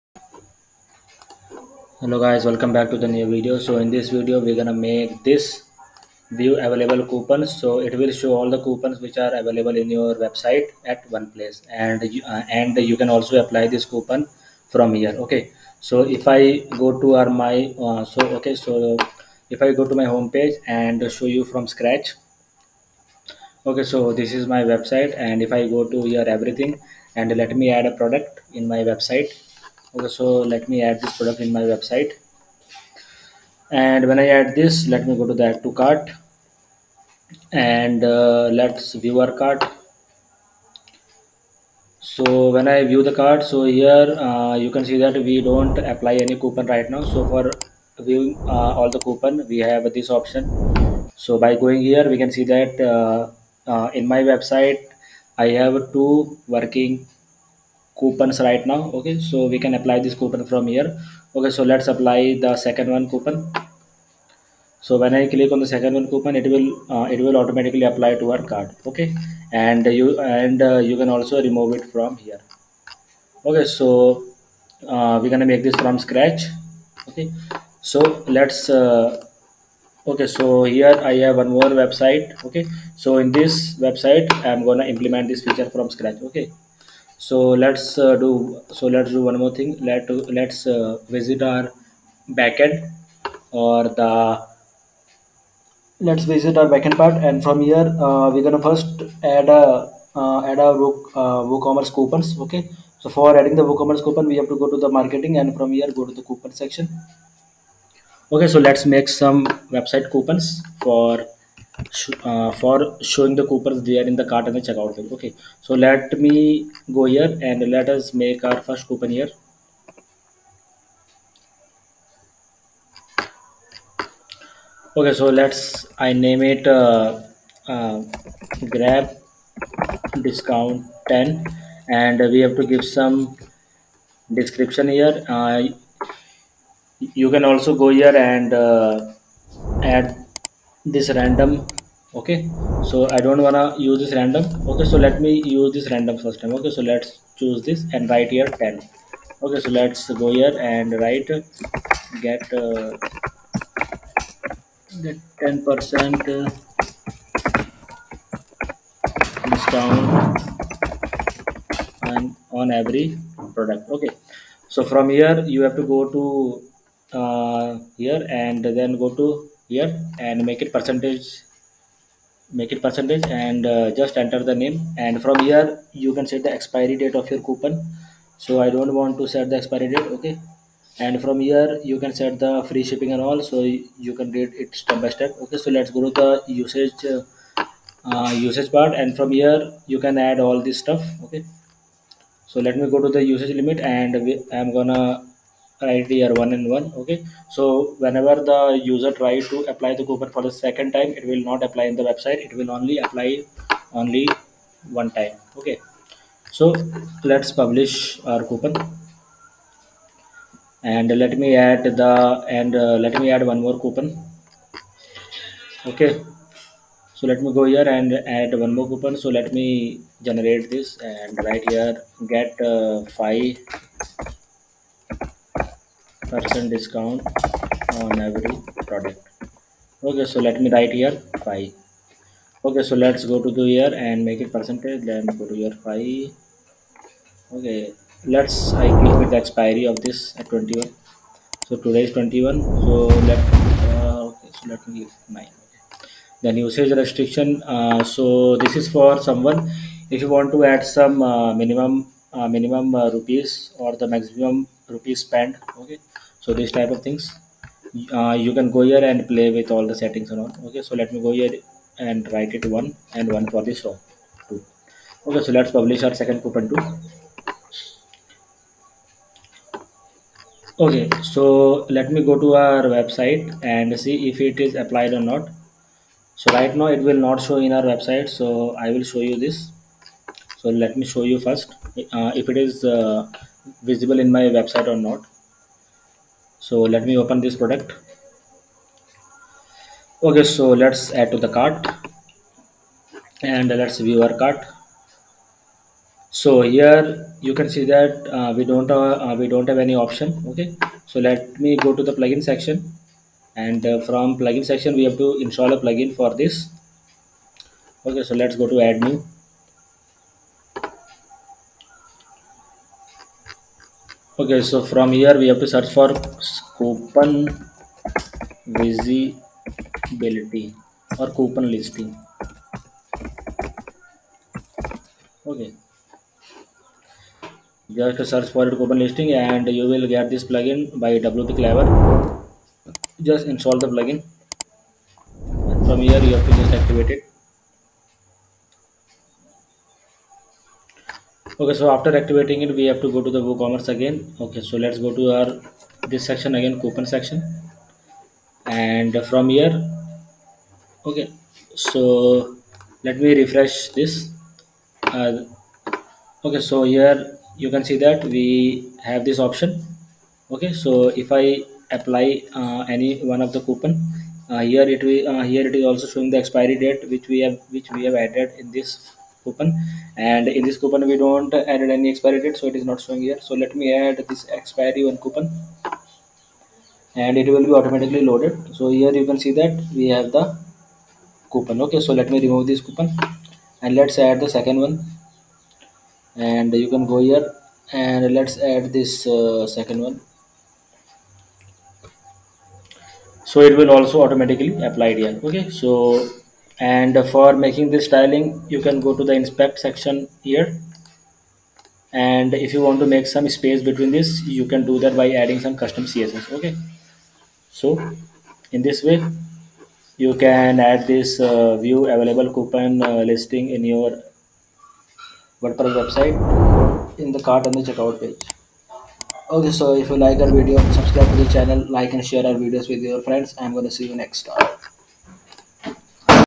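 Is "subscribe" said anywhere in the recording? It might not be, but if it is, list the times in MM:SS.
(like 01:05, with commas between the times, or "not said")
07:00.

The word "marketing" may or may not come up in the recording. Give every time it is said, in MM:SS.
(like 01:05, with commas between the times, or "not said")
01:44.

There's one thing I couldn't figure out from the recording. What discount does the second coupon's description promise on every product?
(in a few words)
5 percent.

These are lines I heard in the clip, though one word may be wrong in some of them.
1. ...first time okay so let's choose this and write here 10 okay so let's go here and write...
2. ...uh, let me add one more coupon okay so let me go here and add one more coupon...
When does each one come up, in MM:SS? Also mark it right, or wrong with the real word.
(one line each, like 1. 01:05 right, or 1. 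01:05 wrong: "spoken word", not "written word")
1. 02:26 right
2. 03:32 right.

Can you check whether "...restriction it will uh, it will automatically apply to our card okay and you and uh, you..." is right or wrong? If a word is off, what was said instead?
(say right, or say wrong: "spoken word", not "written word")
wrong: "coupon", not "restriction".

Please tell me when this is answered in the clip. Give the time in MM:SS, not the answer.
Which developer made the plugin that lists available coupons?
05:31.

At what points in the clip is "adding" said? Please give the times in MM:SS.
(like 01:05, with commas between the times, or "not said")
01:43, 06:45.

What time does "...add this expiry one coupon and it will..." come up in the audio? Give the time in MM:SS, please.
06:14.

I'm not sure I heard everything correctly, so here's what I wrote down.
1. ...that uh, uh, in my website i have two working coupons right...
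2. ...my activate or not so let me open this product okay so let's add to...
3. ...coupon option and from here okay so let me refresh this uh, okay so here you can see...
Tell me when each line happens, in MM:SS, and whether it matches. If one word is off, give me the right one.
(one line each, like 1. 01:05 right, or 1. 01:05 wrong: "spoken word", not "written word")
1. 00:52 right
2. 04:44 wrong: "website", not "activate"
3. 05:46 wrong: "section", not "option".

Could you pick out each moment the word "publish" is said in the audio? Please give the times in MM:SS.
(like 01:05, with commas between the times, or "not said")
03:27, 04:25.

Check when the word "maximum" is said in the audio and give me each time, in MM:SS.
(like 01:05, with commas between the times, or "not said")
04:14.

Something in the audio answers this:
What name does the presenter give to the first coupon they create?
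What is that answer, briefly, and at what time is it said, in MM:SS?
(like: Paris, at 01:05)
grab discount 10, at 02:08.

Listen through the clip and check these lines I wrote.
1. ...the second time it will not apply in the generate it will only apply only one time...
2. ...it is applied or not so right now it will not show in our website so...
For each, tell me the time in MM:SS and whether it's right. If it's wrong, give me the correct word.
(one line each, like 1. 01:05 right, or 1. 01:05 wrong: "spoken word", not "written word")
1. 03:20 wrong: "website", not "generate"
2. 04:34 right.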